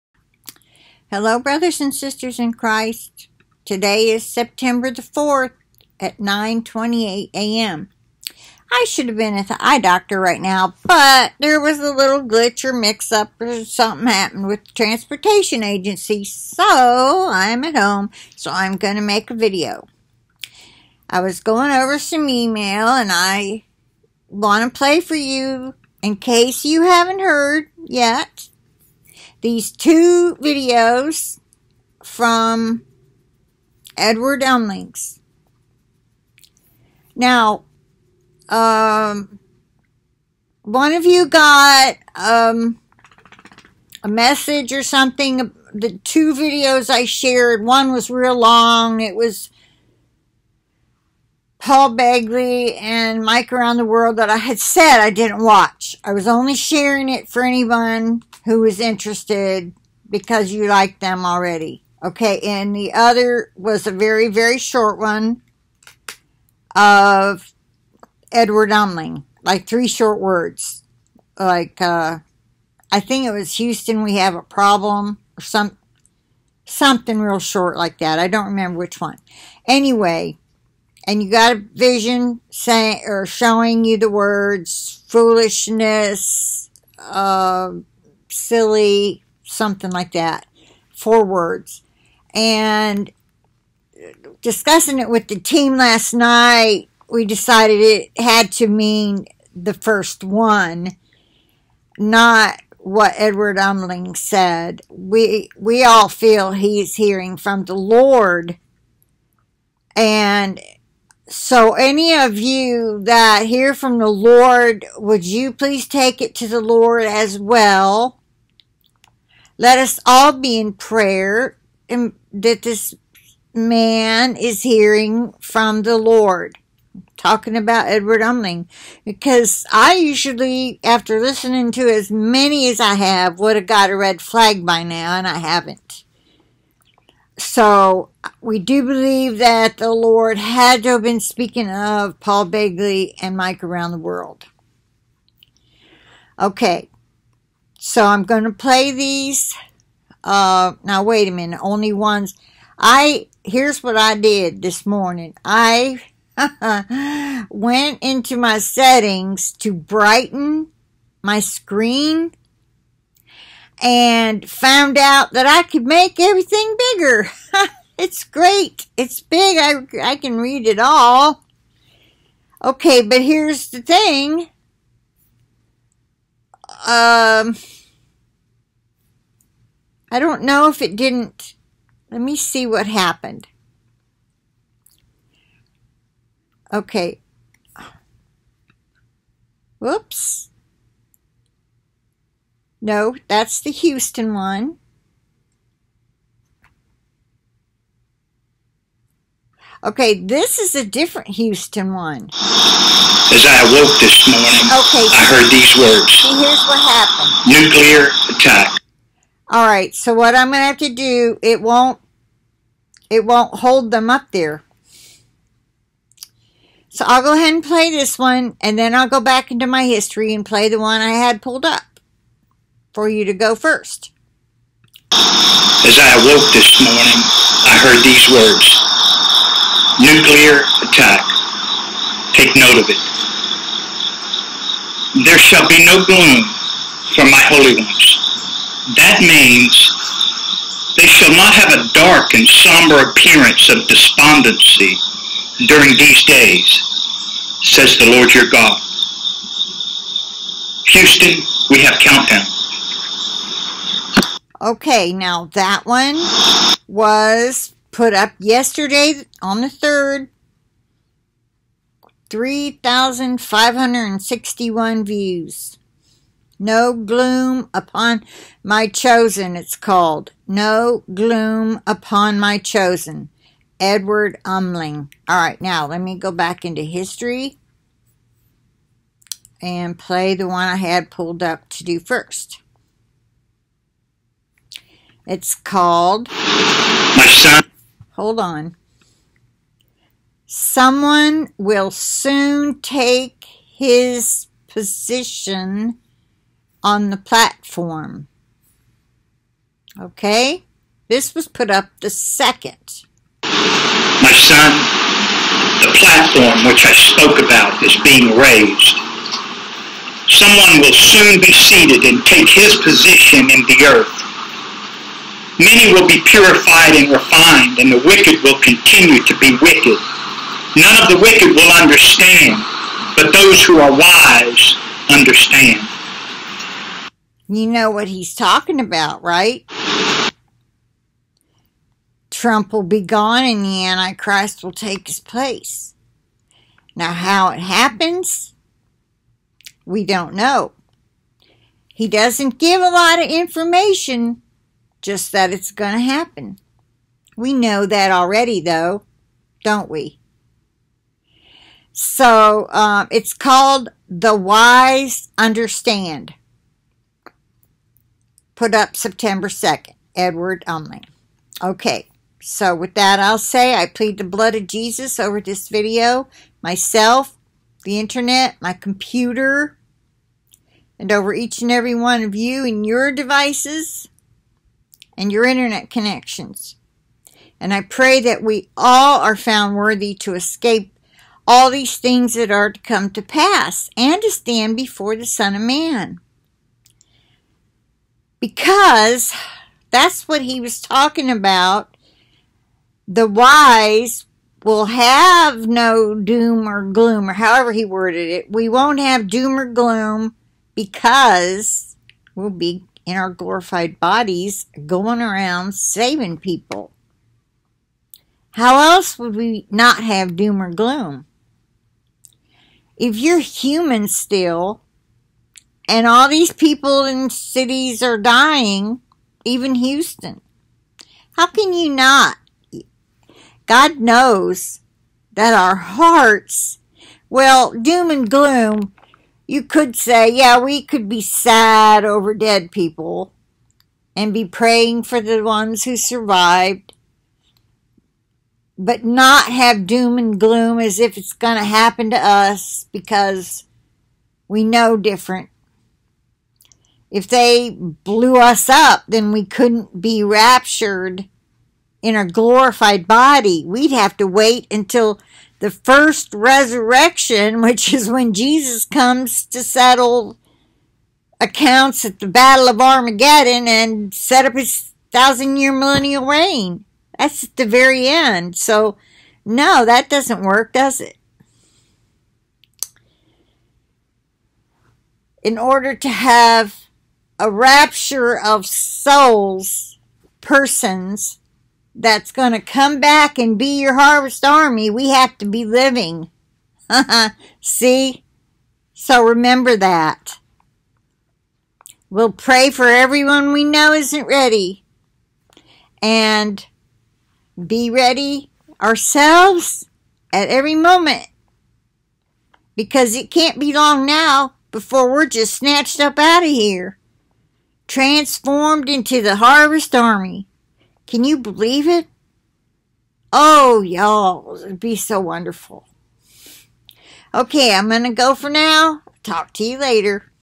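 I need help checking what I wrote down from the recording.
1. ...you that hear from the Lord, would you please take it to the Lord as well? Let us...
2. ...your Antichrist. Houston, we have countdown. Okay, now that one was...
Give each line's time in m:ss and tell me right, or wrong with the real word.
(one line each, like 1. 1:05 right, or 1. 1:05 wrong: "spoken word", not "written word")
1. 1:52 right
2. 4:08 wrong: "God", not "Antichrist".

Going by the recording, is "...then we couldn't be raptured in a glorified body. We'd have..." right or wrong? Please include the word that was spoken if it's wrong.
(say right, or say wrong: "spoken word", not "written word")
right.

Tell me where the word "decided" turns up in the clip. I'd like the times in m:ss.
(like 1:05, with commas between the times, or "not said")
1:37.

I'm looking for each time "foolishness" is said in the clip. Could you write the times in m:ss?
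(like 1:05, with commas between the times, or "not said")
1:25.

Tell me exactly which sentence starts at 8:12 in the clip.
We'll pray for everyone we know isn't ready.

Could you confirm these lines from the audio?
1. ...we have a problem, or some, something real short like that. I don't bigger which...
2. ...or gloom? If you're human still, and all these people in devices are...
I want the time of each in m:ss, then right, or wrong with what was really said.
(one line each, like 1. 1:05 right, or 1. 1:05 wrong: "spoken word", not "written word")
1. 1:14 wrong: "remember", not "bigger"
2. 6:50 wrong: "cities", not "devices".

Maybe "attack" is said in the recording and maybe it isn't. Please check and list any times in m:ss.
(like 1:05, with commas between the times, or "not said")
3:28, 3:50.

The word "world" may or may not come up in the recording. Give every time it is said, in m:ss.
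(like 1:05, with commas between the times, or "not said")
0:53, 2:23.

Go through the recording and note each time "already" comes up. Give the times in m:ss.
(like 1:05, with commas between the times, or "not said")
1:01, 5:48.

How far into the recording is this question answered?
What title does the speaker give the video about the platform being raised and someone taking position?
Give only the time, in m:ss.
5:54.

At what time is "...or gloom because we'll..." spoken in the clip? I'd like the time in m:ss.
6:39.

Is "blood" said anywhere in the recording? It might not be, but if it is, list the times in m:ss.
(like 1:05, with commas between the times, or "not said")
6:04.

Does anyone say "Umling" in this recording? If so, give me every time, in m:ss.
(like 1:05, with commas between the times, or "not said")
0:34, 1:08, 1:43, 2:08, 4:34, 6:00.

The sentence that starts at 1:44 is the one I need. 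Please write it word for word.
We we all feel he's hearing from the Lord.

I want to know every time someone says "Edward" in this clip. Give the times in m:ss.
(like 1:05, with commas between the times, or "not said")
0:33, 1:08, 1:43, 2:07, 4:33, 6:00.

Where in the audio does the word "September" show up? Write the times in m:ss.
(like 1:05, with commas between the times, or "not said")
0:04, 5:58.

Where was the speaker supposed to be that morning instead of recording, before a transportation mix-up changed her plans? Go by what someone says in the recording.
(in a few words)
eye doctor.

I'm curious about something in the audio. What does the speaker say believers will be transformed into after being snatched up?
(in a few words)
the harvest army.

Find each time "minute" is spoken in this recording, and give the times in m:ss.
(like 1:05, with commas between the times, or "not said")
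2:31.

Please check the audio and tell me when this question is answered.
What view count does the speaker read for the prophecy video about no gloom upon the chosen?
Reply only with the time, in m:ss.
4:22.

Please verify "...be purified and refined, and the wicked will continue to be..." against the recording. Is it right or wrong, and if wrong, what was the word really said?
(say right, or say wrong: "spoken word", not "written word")
right.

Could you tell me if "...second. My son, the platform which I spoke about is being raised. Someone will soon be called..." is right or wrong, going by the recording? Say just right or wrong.
wrong.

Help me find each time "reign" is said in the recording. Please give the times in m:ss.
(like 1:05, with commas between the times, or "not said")
7:46.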